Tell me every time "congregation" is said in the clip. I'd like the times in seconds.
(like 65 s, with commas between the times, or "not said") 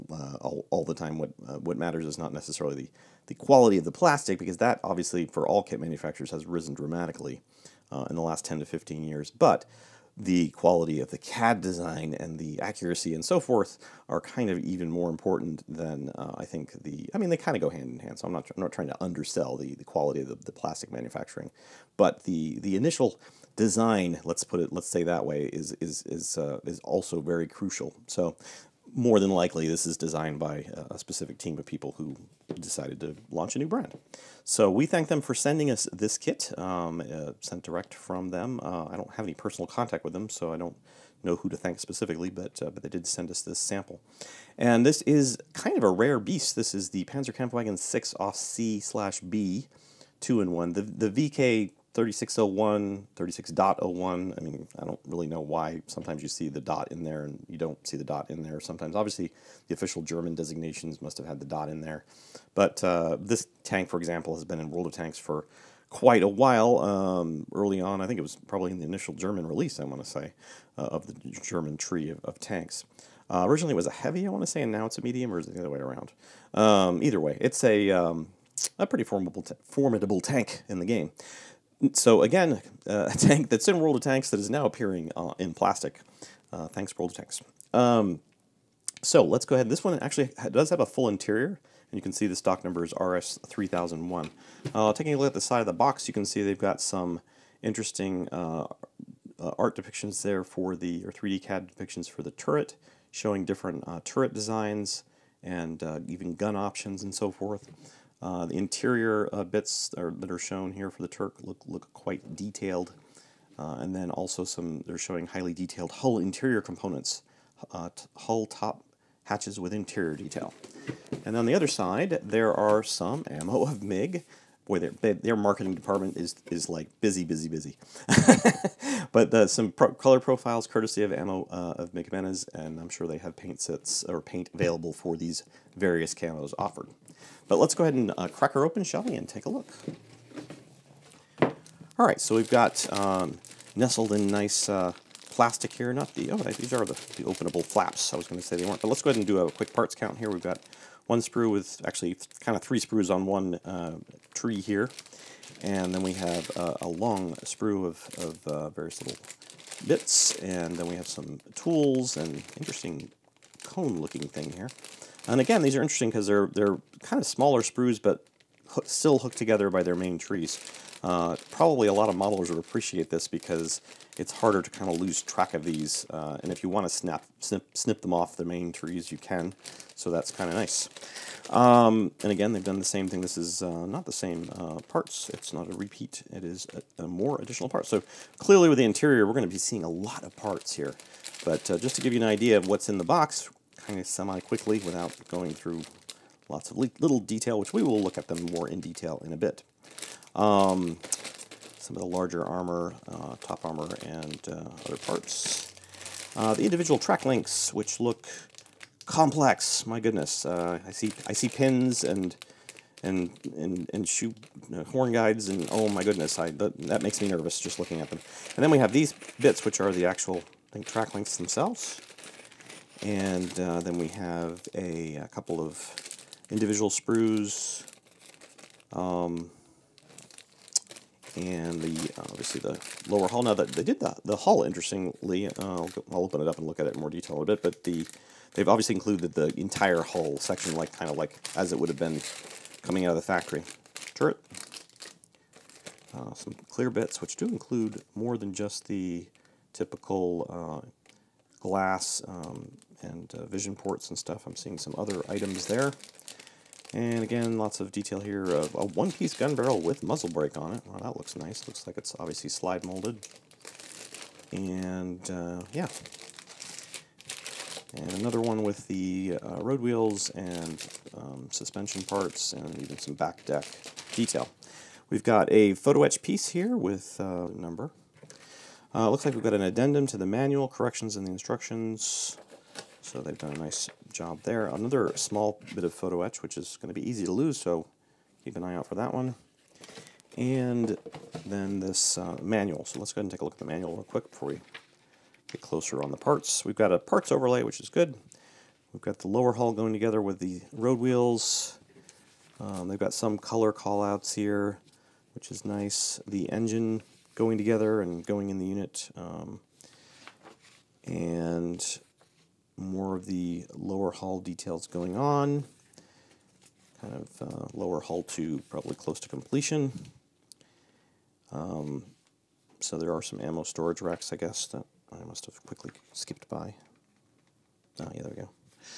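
not said.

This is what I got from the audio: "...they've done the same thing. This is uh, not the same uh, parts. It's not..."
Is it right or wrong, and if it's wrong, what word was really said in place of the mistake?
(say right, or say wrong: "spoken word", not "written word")
right.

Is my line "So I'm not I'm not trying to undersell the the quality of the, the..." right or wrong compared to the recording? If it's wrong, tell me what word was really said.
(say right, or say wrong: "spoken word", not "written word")
right.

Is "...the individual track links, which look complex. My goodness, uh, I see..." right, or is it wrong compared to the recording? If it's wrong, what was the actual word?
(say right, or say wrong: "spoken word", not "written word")
right.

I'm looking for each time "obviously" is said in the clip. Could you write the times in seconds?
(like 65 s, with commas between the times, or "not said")
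4 s, 58 s, 232 s, 238 s, 262 s.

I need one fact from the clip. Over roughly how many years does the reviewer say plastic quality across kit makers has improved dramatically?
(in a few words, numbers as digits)
10 to 15 years.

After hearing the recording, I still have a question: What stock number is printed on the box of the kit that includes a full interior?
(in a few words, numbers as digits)
RS3001.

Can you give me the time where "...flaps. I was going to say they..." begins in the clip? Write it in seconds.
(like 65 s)
147 s.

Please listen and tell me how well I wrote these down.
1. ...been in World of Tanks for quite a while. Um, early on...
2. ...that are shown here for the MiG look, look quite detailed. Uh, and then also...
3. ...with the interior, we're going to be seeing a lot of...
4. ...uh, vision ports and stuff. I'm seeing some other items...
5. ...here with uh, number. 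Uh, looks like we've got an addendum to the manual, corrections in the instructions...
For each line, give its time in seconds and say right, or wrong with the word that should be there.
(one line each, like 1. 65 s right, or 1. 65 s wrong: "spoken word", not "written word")
1. 64 s right
2. 110 s wrong: "Turk", not "MiG"
3. 188 s right
4. 253 s right
5. 276 s right.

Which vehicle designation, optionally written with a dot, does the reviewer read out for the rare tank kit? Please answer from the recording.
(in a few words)
VK 3601.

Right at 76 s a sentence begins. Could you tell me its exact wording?
Um, either way, it's a, um, a pretty formidable, formidable tank in the game.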